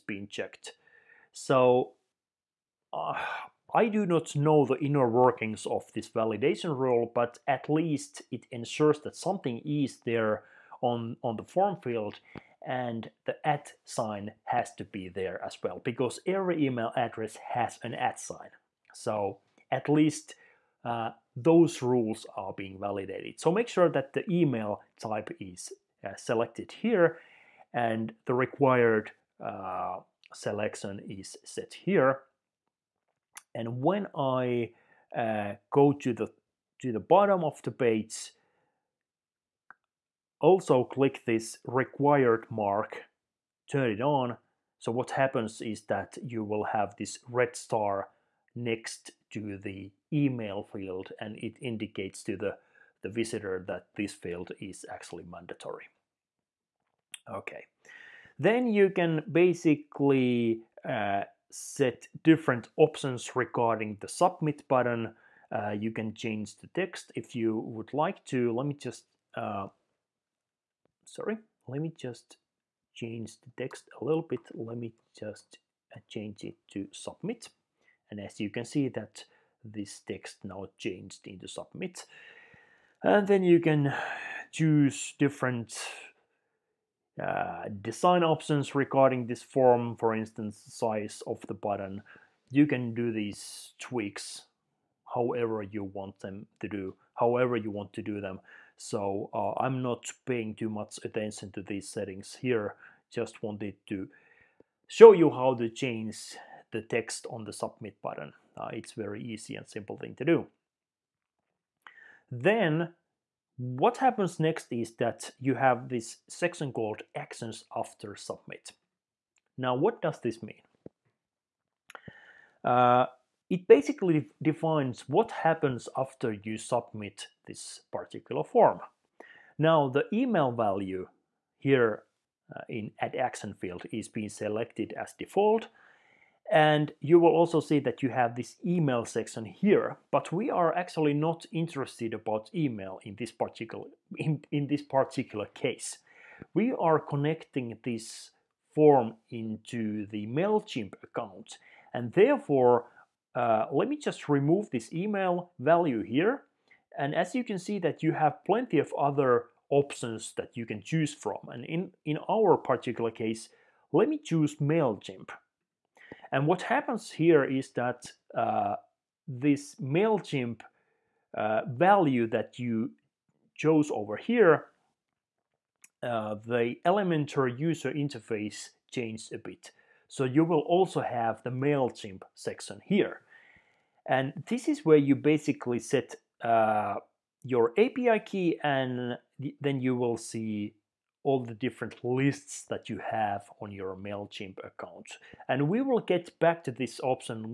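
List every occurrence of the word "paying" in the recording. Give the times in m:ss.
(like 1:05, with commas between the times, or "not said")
1:40.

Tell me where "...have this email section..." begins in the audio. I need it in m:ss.
2:18.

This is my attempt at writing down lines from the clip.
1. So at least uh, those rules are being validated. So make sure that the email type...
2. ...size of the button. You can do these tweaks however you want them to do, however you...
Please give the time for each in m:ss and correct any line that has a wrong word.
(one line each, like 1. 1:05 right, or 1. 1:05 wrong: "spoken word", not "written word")
1. 0:18 right
2. 1:30 right.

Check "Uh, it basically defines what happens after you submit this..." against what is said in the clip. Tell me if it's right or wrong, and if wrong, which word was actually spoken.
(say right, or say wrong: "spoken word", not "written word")
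right.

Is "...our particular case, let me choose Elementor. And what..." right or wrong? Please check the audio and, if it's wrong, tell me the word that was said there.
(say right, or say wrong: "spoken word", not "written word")
wrong: "MailChimp", not "Elementor".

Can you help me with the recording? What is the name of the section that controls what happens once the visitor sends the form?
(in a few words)
actions after submit.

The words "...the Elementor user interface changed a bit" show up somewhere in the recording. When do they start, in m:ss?
2:56.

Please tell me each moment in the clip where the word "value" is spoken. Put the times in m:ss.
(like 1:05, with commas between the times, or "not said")
2:10, 2:35, 2:51.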